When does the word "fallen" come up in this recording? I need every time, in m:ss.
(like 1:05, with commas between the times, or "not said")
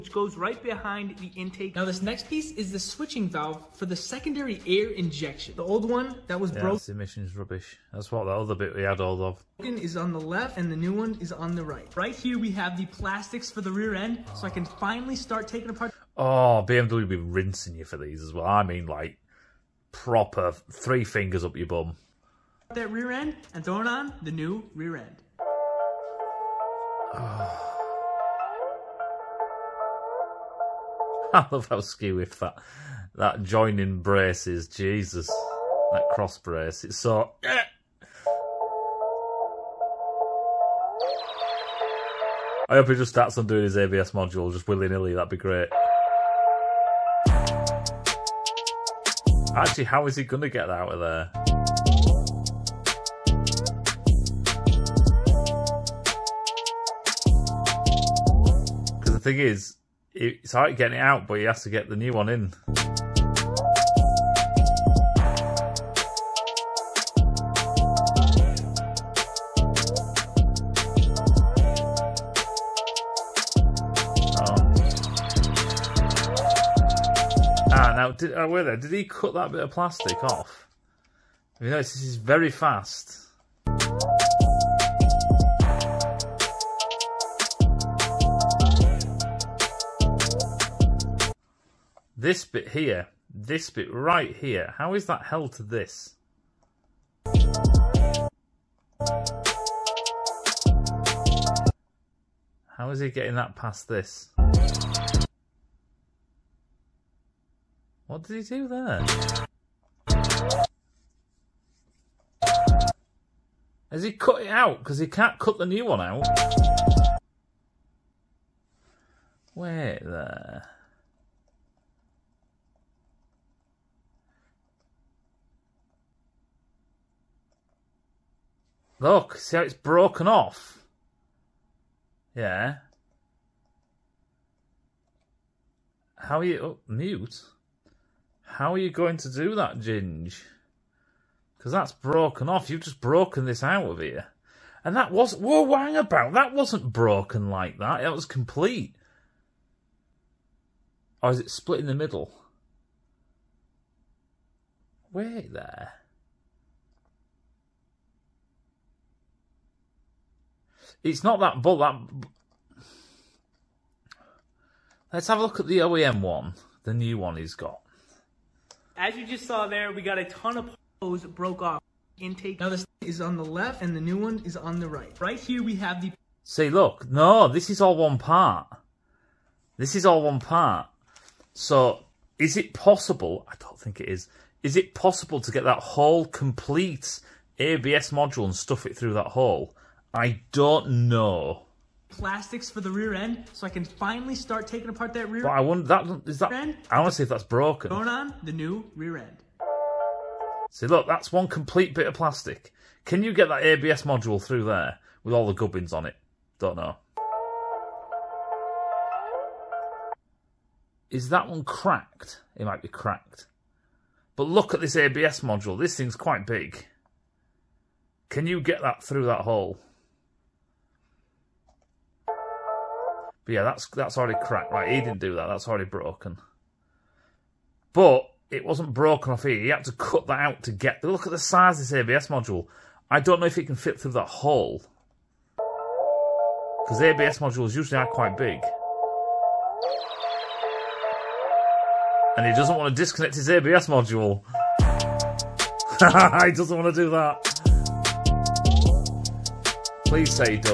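not said.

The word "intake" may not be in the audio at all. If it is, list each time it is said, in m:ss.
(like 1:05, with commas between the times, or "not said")
0:01, 2:52.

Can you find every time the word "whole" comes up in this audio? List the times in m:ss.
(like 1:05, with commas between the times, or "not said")
3:05.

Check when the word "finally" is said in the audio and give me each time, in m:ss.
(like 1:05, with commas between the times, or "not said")
0:14, 3:13.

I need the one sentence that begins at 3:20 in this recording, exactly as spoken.
See look, that's one complete bit of plastic.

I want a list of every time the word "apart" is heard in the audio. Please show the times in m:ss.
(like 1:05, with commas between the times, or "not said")
0:15, 3:14.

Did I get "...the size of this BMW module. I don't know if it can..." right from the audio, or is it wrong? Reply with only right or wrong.
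wrong.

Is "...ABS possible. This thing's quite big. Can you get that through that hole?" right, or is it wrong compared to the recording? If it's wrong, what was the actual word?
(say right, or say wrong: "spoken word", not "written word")
wrong: "module", not "possible".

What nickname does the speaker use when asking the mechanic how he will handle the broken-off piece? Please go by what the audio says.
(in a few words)
Ginge.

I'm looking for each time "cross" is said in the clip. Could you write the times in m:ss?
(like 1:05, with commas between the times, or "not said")
0:36.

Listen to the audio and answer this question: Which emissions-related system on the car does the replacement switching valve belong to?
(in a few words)
Secondary air injection.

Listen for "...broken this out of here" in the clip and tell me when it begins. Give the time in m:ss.
2:22.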